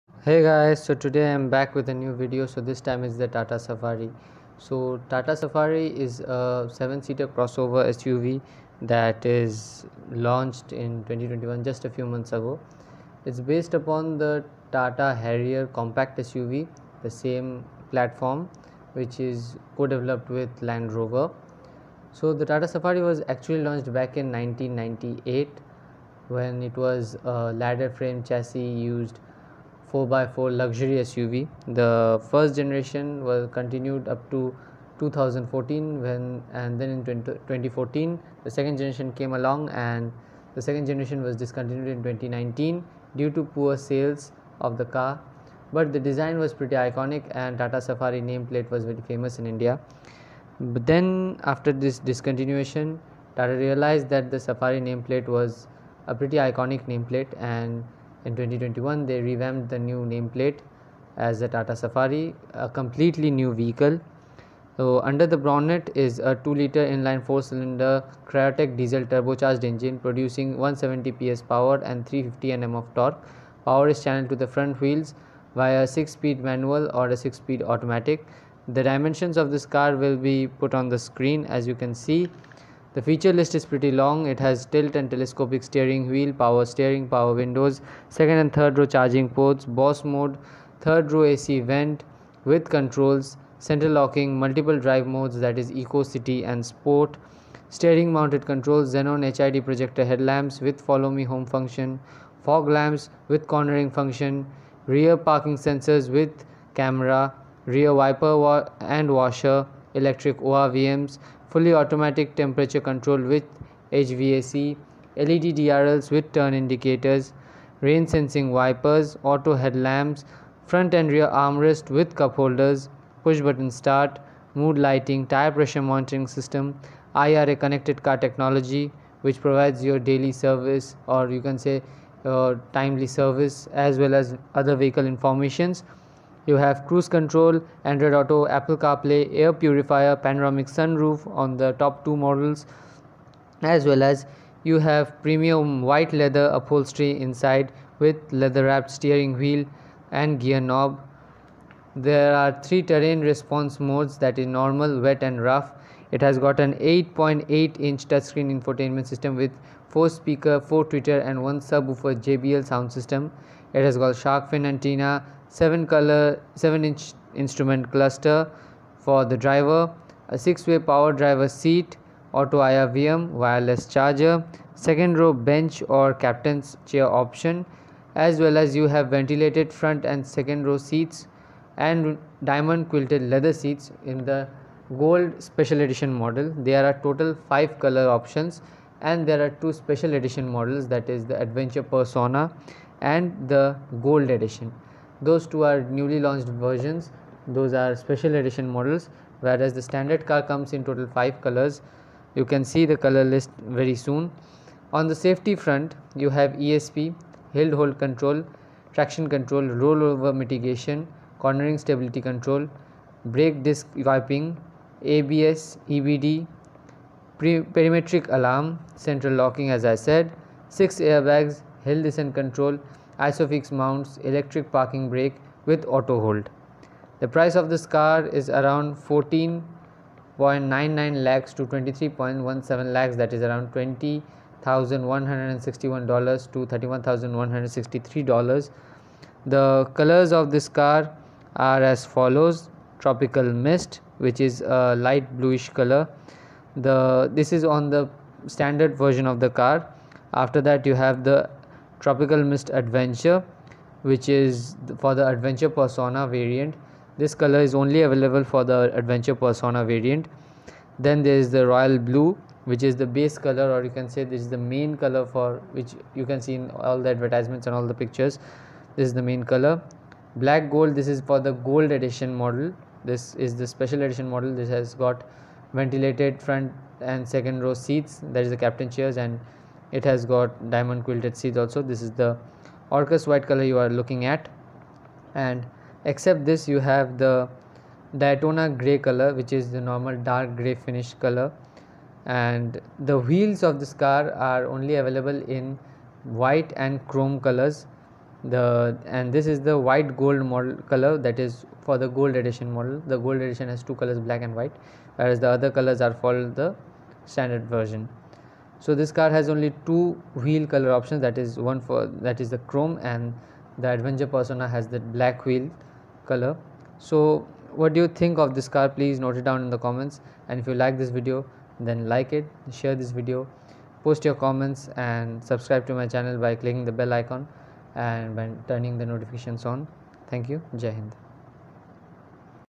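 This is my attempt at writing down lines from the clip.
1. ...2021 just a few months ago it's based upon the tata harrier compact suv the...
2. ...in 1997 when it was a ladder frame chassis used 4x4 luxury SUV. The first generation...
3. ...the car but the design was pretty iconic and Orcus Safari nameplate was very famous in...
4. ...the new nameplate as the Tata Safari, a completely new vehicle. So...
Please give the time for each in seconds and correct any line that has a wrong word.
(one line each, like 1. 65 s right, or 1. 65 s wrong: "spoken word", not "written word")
1. 11 s right
2. 24 s wrong: "1998", not "1997"
3. 44 s wrong: "Tata", not "Orcus"
4. 59 s right.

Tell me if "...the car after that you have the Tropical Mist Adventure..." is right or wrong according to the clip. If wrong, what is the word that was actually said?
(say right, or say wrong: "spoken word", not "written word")
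right.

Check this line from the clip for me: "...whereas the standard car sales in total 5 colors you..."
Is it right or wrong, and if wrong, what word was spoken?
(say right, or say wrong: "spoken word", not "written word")
wrong: "comes", not "sales".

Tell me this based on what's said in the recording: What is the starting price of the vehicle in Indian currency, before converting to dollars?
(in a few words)
14.99 lakhs.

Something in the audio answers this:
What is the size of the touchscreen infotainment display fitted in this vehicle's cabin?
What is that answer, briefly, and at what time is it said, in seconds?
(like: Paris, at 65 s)
8.8 inch, at 156 s.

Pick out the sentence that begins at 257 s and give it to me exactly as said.
This color is only available for the Adventure Persona variant.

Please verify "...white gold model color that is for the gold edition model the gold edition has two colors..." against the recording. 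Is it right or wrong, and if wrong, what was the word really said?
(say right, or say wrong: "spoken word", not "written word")
right.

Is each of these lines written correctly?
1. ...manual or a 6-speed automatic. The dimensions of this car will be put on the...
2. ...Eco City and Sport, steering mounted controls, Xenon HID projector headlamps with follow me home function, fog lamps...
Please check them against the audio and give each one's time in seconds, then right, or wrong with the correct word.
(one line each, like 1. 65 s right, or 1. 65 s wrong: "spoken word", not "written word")
1. 76 s right
2. 95 s right.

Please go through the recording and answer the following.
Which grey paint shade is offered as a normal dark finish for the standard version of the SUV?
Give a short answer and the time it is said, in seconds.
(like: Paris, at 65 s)
Daytona gray, at 288 s.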